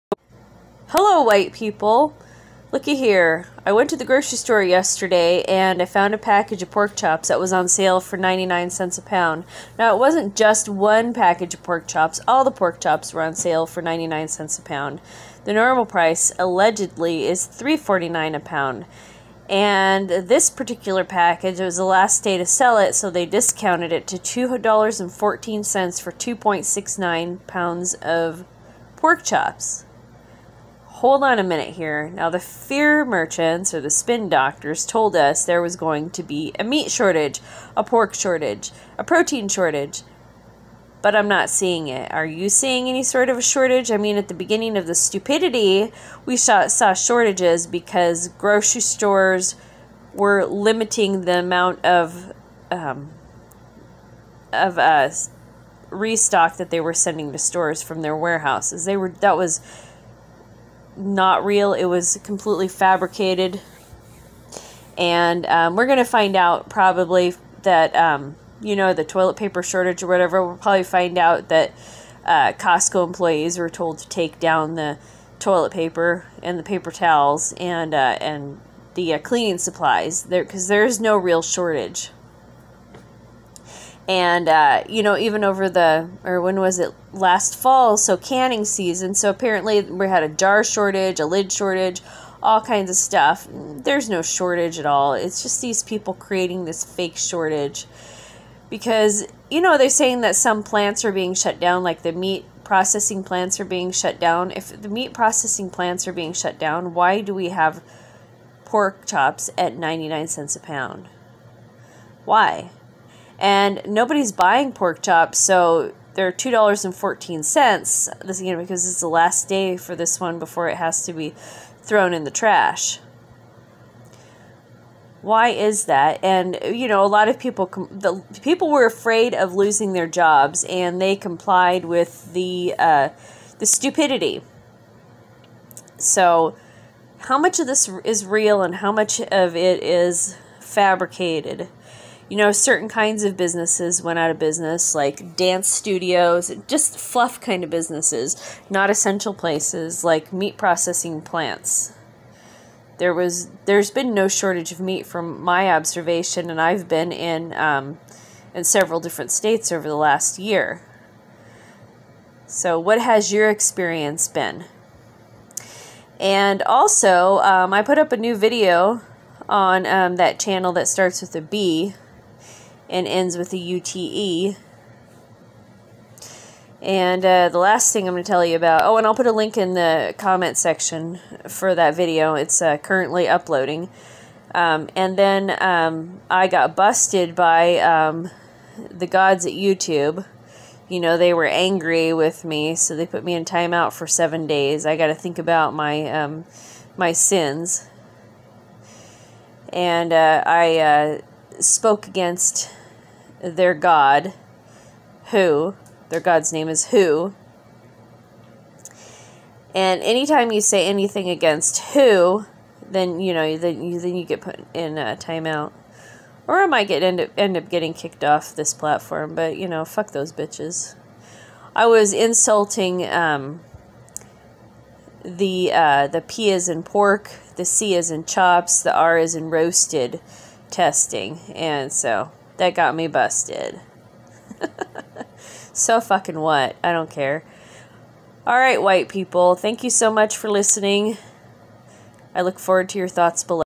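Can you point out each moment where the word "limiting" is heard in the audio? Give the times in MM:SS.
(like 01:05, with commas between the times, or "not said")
00:50.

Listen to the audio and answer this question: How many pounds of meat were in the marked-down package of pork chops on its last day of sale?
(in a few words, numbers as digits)
2.69 pounds.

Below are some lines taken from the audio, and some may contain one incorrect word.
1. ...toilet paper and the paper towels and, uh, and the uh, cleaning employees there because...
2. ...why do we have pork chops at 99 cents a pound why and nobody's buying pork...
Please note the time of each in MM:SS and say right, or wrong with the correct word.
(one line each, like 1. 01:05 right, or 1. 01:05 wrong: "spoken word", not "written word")
1. 01:15 wrong: "supplies", not "employees"
2. 01:46 right.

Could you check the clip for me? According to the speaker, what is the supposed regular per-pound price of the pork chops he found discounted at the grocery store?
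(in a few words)
$3.49.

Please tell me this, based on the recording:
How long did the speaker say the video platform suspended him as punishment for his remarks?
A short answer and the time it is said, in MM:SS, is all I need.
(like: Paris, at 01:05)
7 days, at 03:14.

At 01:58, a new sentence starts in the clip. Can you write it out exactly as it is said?
This again because it's the last day for this one before it has to be thrown in the trash.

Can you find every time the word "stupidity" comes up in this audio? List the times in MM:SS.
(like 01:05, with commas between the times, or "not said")
00:44, 02:13.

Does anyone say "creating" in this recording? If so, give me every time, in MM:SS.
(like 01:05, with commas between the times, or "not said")
01:36.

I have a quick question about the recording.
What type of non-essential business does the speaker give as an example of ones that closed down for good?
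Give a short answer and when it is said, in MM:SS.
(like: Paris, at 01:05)
Dance studios, at 02:25.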